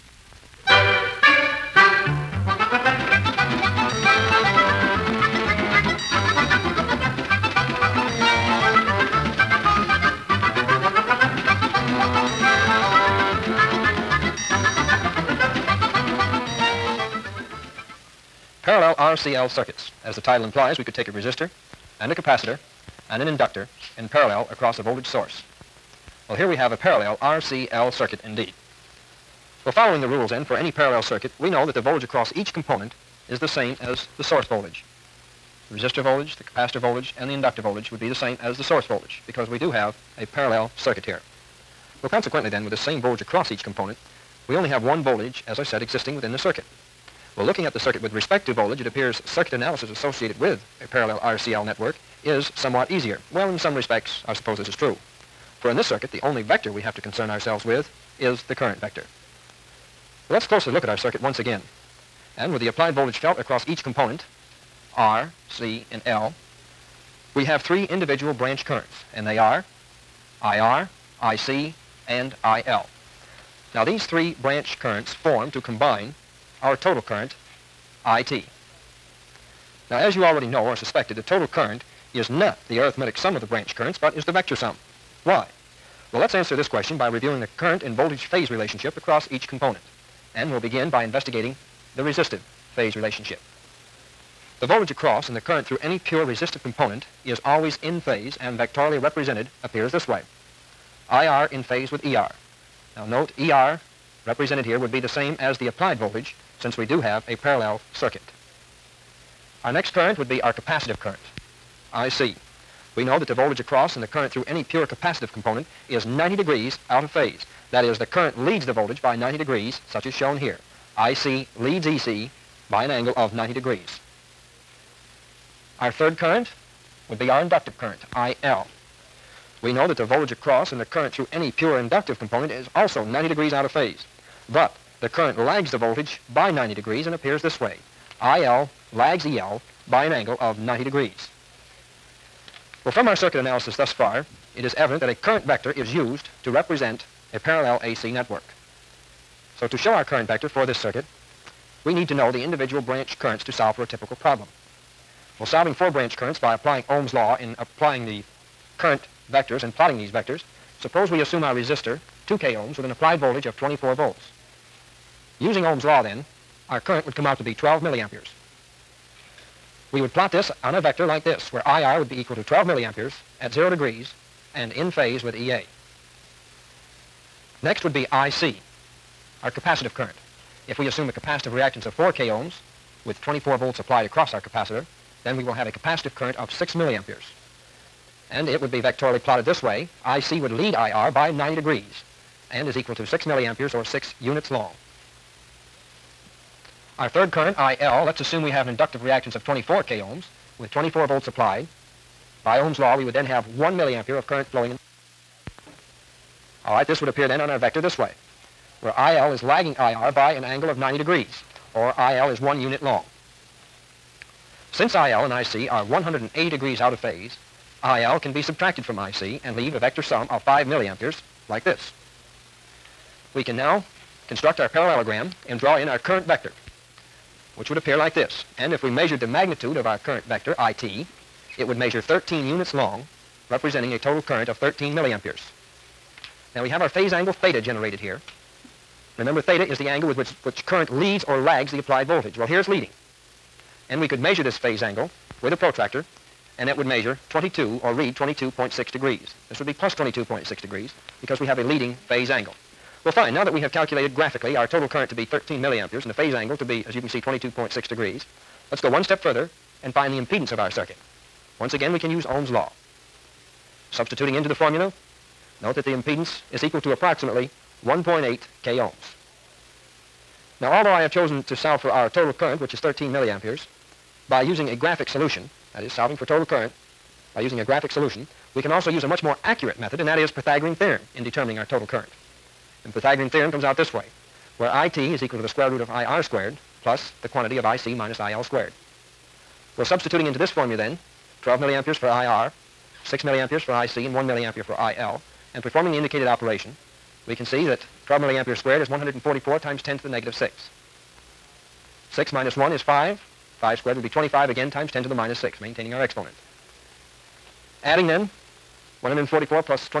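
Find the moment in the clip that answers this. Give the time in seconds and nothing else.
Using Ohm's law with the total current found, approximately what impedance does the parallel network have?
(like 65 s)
267 s.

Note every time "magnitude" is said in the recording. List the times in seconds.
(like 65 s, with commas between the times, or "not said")
229 s.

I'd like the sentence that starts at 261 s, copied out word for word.
Once again, we can use Ohm's law.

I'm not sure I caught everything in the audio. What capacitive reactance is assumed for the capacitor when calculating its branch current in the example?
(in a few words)
4 k ohms.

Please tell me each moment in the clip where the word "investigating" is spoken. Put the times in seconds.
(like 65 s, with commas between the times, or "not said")
91 s.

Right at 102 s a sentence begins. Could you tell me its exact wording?
Now note ER represented here would be the same as the applied voltage since we do have a parallel circuit.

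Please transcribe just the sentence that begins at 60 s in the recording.
Let's closely look at our circuit once again.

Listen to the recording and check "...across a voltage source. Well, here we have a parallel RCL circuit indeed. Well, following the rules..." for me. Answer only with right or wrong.
right.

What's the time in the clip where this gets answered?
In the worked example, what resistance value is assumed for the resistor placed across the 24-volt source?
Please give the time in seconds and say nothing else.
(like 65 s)
162 s.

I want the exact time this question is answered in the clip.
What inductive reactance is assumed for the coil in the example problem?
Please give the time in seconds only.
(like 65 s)
199 s.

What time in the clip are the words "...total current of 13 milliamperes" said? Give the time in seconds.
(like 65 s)
233 s.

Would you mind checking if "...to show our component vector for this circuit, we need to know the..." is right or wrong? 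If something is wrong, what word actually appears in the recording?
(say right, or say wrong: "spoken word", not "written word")
wrong: "current", not "component".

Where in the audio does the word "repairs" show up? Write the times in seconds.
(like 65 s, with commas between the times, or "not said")
not said.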